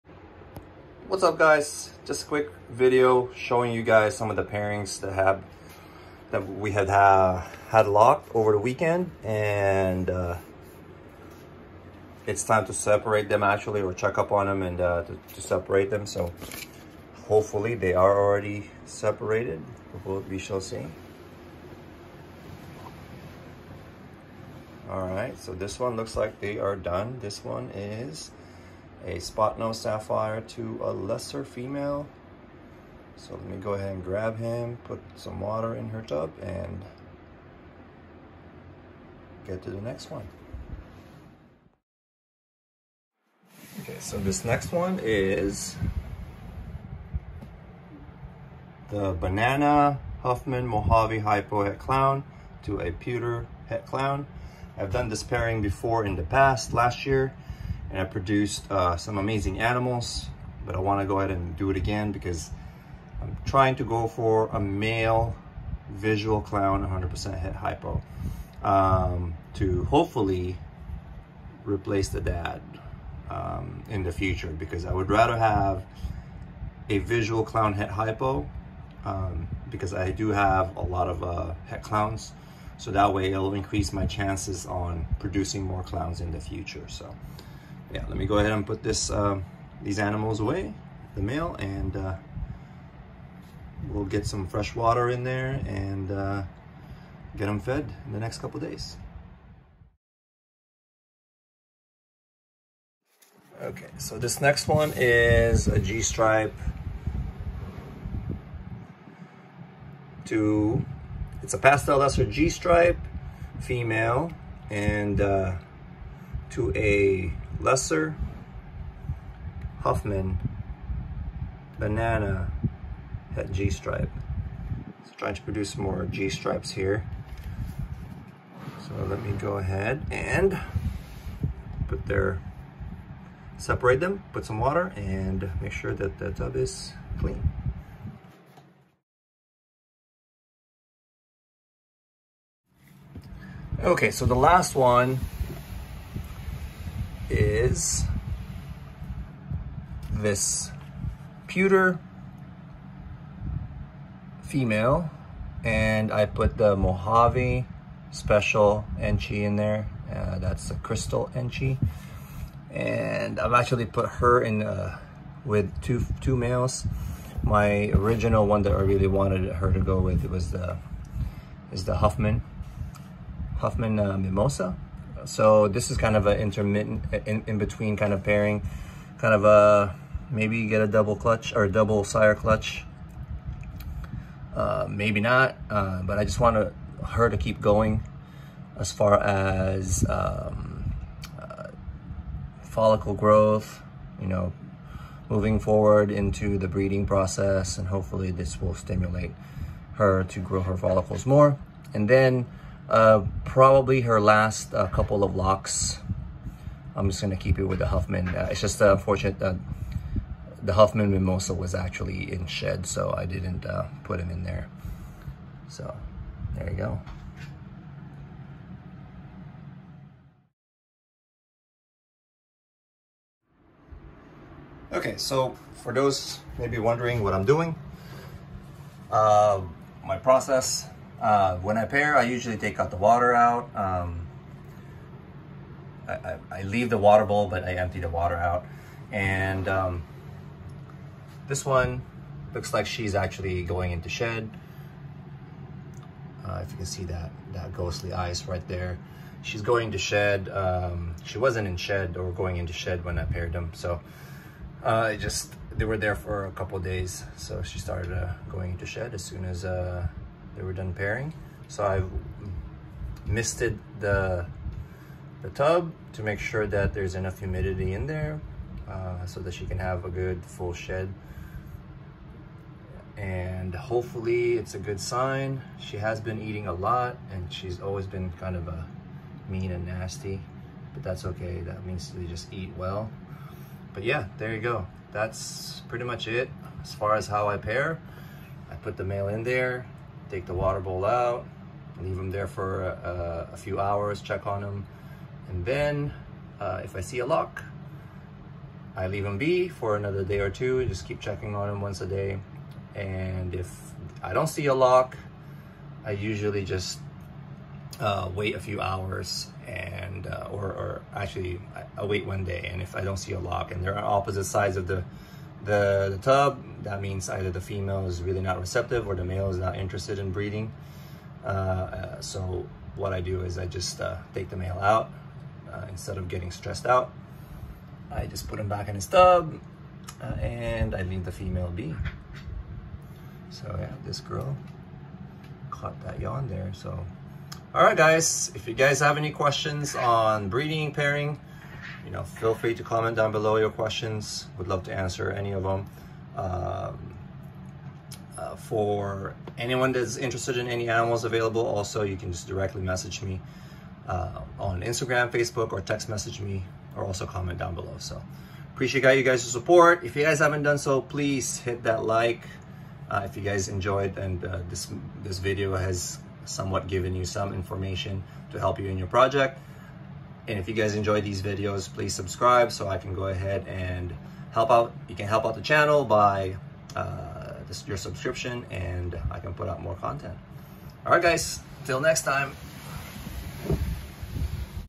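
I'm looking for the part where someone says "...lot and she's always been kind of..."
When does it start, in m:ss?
4:36.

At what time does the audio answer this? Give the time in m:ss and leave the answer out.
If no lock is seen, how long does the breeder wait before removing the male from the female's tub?
5:12.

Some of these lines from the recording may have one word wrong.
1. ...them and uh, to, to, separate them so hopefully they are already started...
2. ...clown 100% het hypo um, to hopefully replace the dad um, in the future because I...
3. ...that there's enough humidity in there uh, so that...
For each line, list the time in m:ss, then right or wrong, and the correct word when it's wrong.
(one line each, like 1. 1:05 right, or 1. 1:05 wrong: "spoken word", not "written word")
1. 0:14 wrong: "separated", not "started"
2. 1:06 right
3. 4:26 right.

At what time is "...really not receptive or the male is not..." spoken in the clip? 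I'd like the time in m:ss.
5:18.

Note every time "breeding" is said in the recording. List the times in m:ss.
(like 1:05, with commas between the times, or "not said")
3:16, 5:20, 5:40.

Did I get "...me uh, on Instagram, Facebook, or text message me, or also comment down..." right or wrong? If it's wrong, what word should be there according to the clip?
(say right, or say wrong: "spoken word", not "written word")
right.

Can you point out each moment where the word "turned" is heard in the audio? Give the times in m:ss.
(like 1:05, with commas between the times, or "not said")
not said.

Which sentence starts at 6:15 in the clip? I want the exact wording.
You can help out the channel by uh, your subscription and I can put out more content.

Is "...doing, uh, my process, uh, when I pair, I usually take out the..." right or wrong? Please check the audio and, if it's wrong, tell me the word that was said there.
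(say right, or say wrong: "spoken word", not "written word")
right.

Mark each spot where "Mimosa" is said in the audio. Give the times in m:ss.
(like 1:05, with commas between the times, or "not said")
2:54, 3:31.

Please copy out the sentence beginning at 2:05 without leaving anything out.
So trying to produce more G-stripes here.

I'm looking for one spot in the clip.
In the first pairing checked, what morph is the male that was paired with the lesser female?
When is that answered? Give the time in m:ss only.
0:29.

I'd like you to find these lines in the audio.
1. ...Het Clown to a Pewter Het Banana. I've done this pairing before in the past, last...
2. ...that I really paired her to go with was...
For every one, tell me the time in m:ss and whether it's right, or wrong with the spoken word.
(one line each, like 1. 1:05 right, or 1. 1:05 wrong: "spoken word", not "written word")
1. 0:51 wrong: "Clown", not "Banana"
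2. 2:48 wrong: "wanted", not "paired".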